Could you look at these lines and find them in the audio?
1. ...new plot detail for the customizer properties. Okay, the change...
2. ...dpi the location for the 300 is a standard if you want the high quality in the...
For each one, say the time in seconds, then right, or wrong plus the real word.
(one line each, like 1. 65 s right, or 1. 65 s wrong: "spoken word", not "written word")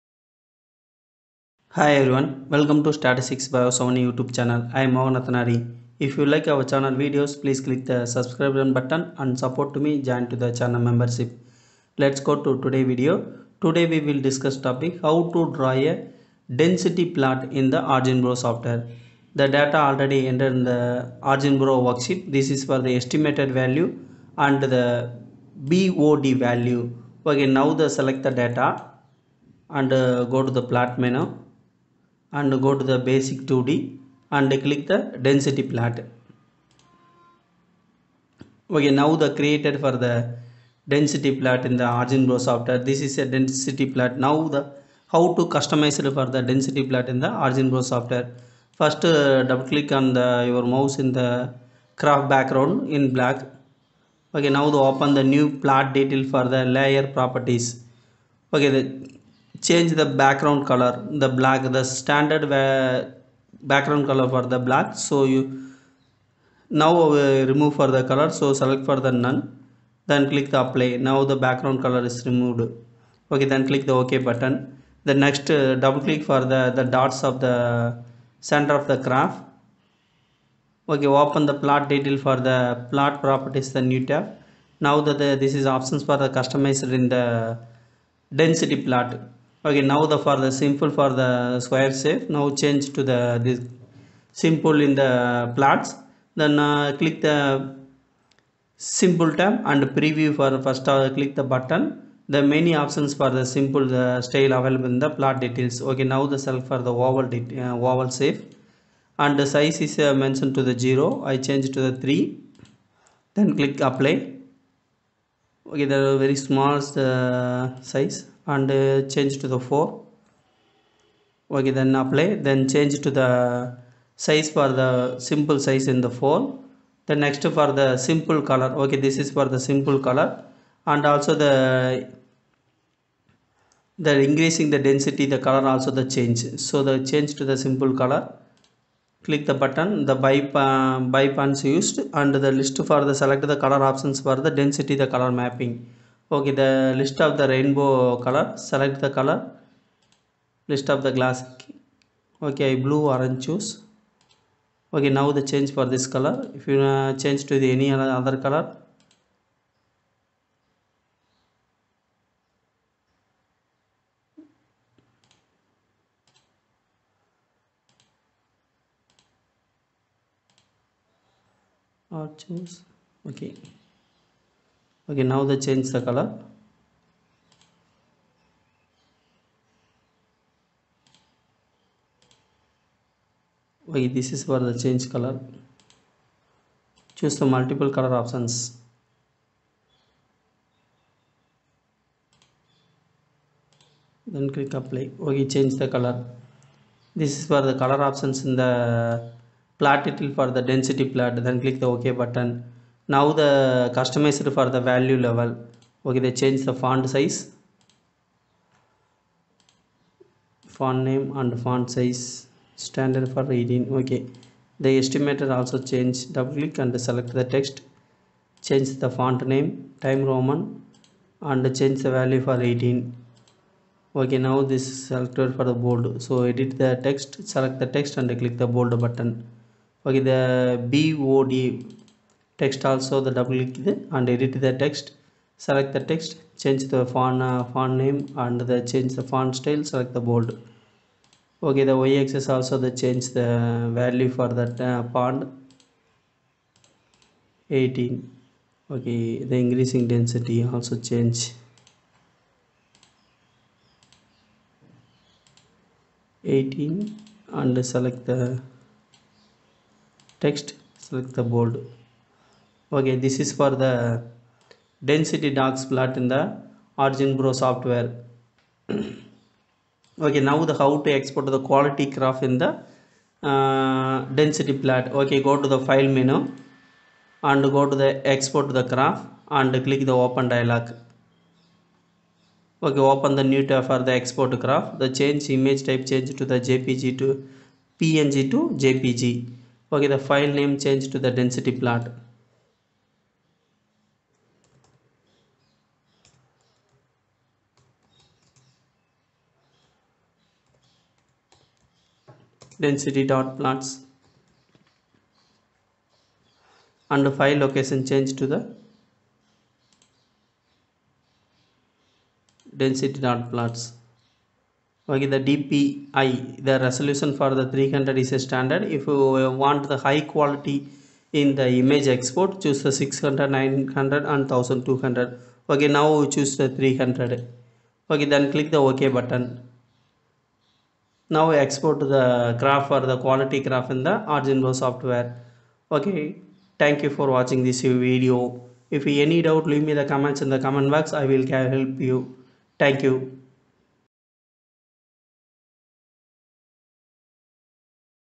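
1. 55 s wrong: "layer", not "customizer"
2. 315 s wrong: "resolution", not "location".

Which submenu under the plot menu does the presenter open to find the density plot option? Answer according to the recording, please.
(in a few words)
Basic 2D.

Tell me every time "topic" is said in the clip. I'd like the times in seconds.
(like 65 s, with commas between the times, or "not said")
14 s.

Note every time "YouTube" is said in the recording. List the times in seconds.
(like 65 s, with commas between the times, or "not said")
4 s.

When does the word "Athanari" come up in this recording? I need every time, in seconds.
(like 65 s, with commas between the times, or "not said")
5 s.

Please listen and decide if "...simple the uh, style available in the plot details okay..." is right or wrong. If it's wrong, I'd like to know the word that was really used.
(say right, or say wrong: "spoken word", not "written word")
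right.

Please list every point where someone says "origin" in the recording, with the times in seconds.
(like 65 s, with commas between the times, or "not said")
41 s, 47 s, 267 s.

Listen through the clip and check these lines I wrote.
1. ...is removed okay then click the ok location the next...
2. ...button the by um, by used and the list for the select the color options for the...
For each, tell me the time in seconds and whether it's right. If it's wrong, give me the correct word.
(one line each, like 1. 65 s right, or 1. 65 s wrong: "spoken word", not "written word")
1. 72 s wrong: "button", not "location"
2. 139 s right.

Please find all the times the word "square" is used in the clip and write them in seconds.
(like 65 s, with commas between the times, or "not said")
91 s.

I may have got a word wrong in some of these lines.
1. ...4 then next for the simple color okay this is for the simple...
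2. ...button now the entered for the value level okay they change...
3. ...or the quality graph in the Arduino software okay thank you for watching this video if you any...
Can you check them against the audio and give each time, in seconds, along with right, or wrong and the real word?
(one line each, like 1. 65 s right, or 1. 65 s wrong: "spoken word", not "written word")
1. 126 s right
2. 202 s wrong: "customized", not "entered"
3. 332 s right.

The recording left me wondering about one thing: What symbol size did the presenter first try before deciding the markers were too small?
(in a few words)
3.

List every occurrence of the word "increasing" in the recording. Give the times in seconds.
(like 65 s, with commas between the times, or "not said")
134 s, 249 s.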